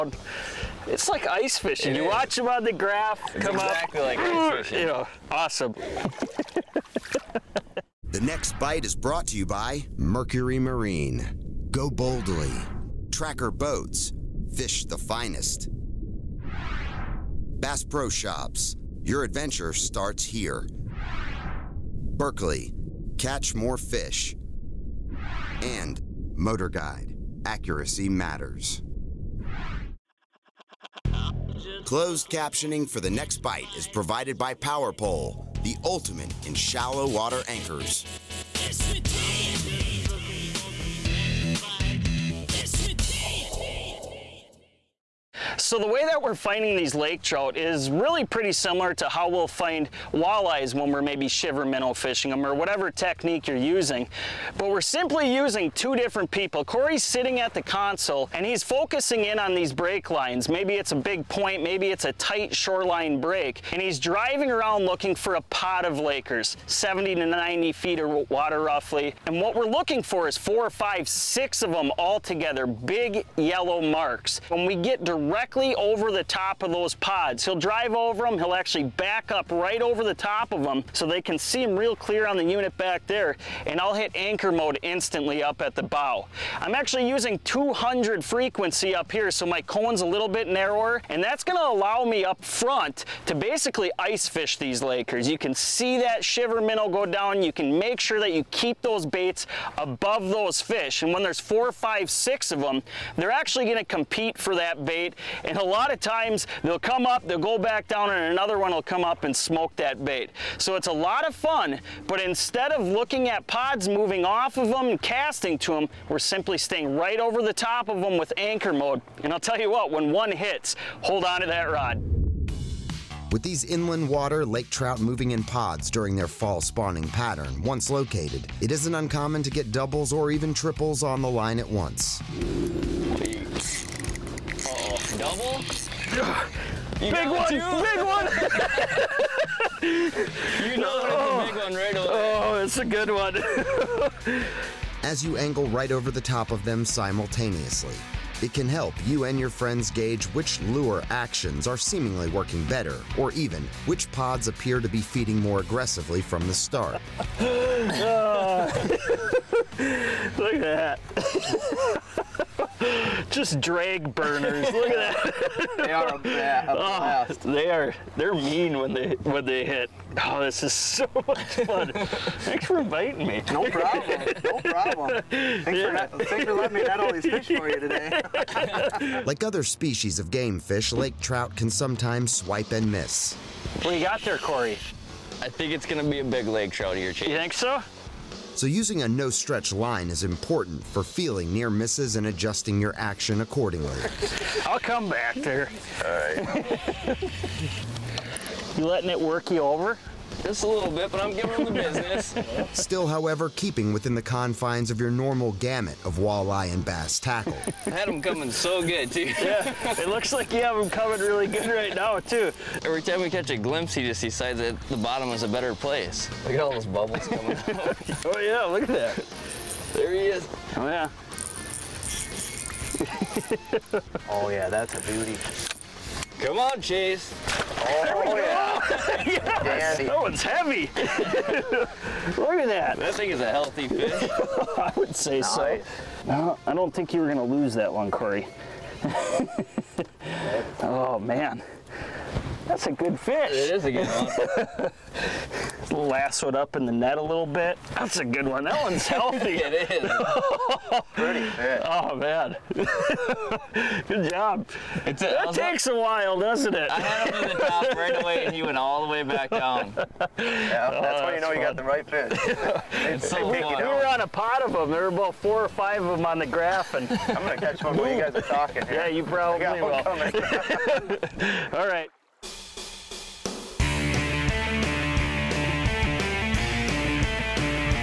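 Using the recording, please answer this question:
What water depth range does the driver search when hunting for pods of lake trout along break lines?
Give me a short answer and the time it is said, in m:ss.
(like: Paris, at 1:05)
70 to 90 feet, at 1:06.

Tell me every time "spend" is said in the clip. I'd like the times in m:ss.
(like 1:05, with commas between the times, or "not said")
not said.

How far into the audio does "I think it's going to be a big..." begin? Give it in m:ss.
3:05.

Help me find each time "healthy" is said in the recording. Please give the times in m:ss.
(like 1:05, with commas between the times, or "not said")
3:53, 4:09.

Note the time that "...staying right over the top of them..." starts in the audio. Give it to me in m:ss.
1:56.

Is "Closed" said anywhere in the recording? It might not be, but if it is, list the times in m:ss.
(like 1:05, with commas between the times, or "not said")
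0:31.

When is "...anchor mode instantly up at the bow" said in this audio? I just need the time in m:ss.
1:24.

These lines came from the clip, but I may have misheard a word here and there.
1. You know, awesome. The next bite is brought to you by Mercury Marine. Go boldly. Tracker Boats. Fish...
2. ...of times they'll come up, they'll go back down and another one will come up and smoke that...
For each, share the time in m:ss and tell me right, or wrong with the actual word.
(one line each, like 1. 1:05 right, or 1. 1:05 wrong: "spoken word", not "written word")
1. 0:04 right
2. 1:45 right.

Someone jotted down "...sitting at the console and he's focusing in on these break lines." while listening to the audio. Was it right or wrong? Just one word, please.
right.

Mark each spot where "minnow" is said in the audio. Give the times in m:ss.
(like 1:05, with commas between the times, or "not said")
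0:51, 1:36.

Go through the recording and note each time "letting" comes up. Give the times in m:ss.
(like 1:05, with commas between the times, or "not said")
2:56, 3:18.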